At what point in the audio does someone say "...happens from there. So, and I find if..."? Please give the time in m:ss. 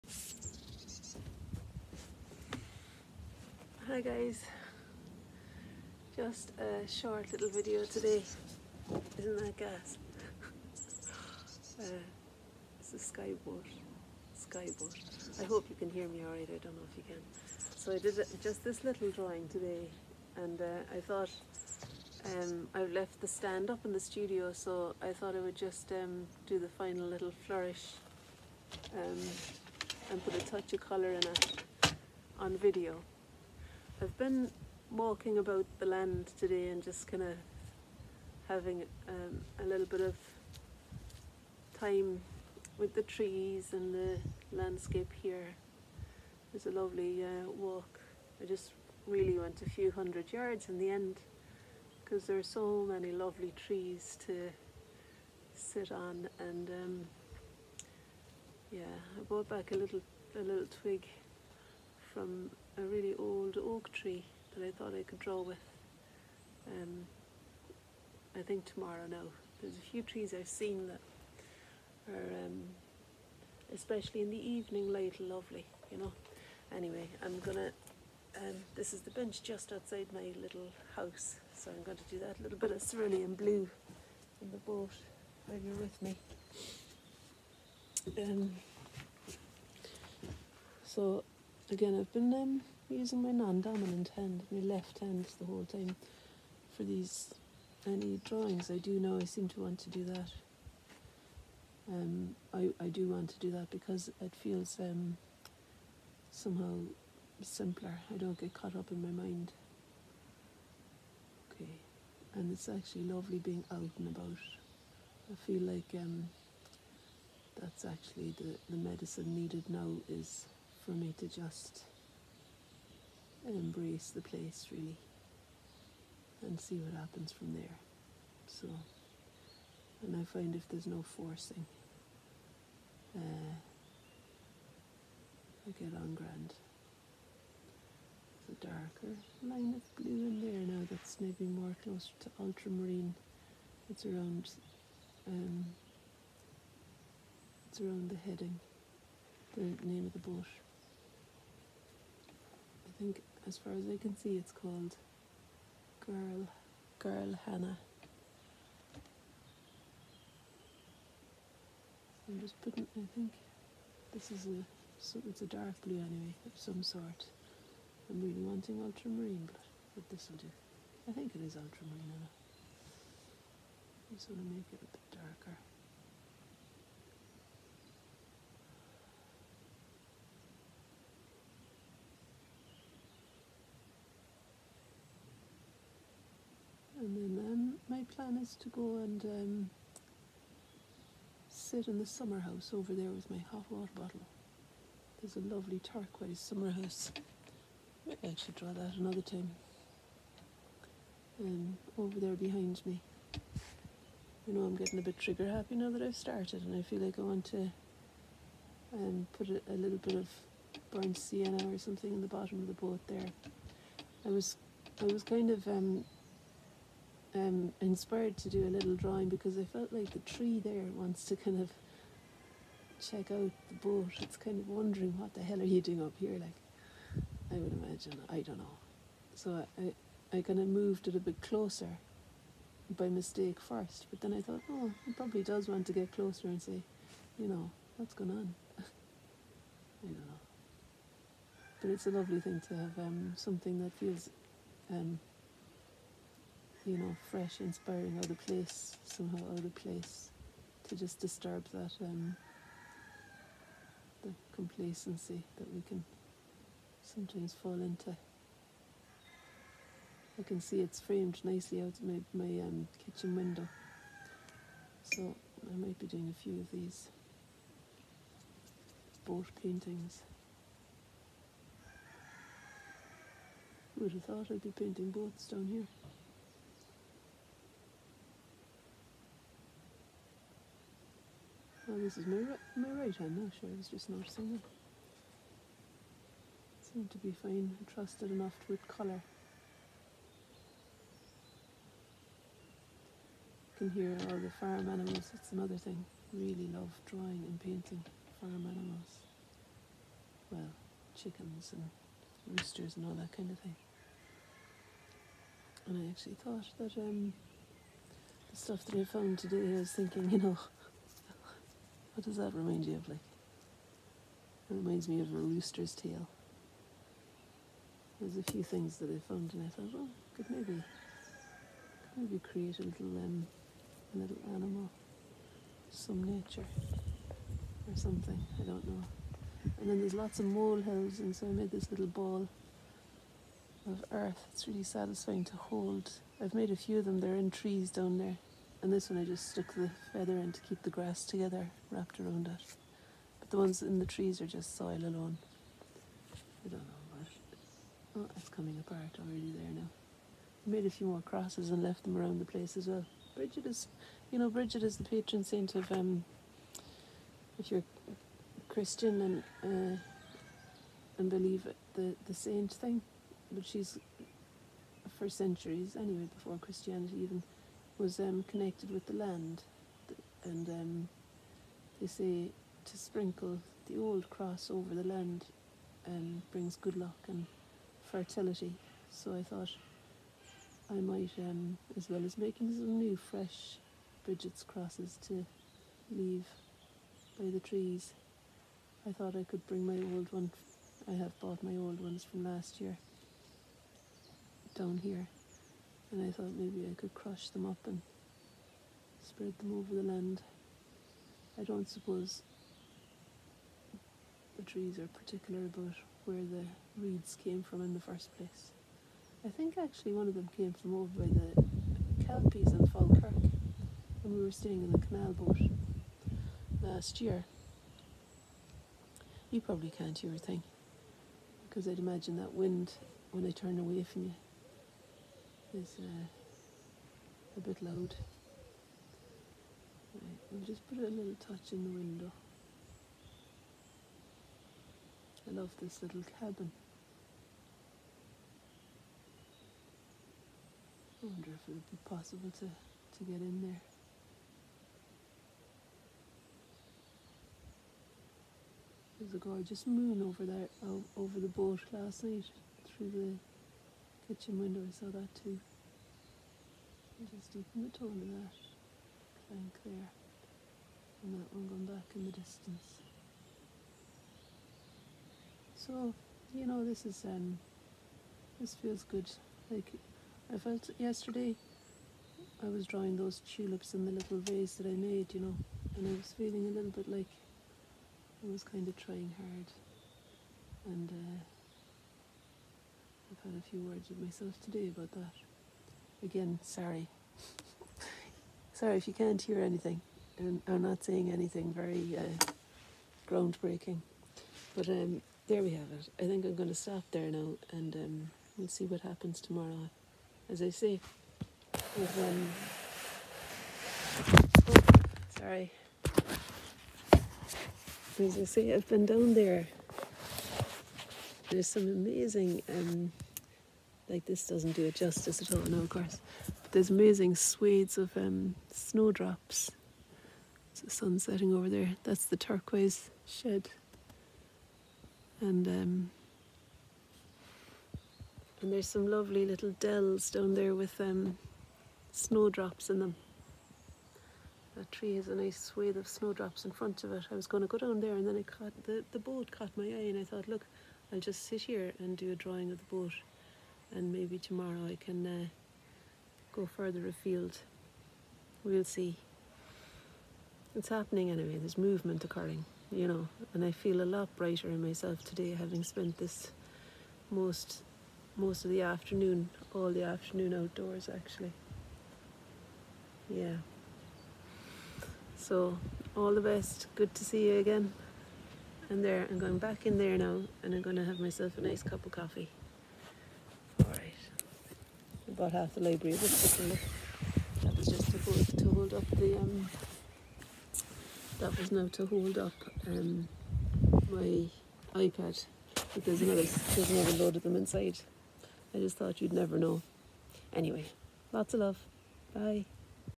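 2:06.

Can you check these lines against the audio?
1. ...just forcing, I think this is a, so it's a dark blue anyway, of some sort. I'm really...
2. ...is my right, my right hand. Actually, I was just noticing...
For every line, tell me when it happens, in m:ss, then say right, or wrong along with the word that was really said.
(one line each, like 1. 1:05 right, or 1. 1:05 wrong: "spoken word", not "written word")
1. 2:42 wrong: "putting", not "forcing"
2. 4:42 right.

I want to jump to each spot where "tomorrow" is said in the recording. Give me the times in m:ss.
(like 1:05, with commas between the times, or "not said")
1:08, 8:19, 9:04.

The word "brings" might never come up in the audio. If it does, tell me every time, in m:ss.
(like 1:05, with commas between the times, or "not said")
6:16, 6:29.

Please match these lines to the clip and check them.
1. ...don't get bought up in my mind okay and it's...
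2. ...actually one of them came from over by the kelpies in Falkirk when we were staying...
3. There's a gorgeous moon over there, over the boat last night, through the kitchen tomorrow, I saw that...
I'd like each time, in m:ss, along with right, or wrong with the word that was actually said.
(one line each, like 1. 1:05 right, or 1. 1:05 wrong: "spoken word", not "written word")
1. 1:48 wrong: "caught", not "bought"
2. 6:49 right
3. 7:29 wrong: "window", not "tomorrow".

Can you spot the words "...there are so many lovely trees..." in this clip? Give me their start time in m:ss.
0:52.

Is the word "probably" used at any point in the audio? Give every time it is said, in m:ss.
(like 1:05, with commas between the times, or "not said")
3:55, 6:59.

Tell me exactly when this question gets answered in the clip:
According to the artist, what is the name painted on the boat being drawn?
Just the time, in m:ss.
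2:36.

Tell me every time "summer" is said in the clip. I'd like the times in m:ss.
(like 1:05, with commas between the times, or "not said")
3:12, 3:16.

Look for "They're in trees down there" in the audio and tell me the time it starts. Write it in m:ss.
5:37.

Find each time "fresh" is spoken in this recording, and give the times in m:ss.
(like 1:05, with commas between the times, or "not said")
4:07, 6:23.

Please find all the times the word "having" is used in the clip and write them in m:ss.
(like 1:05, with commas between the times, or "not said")
0:38, 9:15.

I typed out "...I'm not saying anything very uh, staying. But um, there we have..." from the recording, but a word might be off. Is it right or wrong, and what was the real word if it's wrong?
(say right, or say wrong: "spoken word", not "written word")
wrong: "groundbreaking", not "staying".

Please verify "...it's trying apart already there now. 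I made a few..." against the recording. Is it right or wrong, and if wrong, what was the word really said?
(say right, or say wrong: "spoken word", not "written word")
wrong: "coming", not "trying".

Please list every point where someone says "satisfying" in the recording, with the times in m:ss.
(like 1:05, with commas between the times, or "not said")
5:34.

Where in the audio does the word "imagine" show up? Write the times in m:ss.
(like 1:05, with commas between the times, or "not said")
3:47, 7:01.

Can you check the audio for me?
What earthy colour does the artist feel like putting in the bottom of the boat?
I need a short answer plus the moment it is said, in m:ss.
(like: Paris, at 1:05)
burnt sienna, at 3:30.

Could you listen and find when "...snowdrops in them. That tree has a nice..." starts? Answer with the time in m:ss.
8:52.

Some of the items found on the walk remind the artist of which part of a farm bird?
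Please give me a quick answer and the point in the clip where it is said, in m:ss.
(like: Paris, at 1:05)
a rooster's tail, at 5:15.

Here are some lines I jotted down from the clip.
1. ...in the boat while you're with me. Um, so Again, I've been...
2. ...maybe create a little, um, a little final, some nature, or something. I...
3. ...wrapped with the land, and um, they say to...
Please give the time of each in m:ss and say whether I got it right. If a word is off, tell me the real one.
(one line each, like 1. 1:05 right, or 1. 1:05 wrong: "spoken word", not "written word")
1. 1:24 right
2. 5:22 wrong: "animal", not "final"
3. 6:08 wrong: "connected", not "wrapped".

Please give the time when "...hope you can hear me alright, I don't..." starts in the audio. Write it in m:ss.
0:15.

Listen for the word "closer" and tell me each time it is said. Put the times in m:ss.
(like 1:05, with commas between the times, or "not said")
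2:21, 3:51, 3:56.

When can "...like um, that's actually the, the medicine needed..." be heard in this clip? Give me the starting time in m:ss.
1:55.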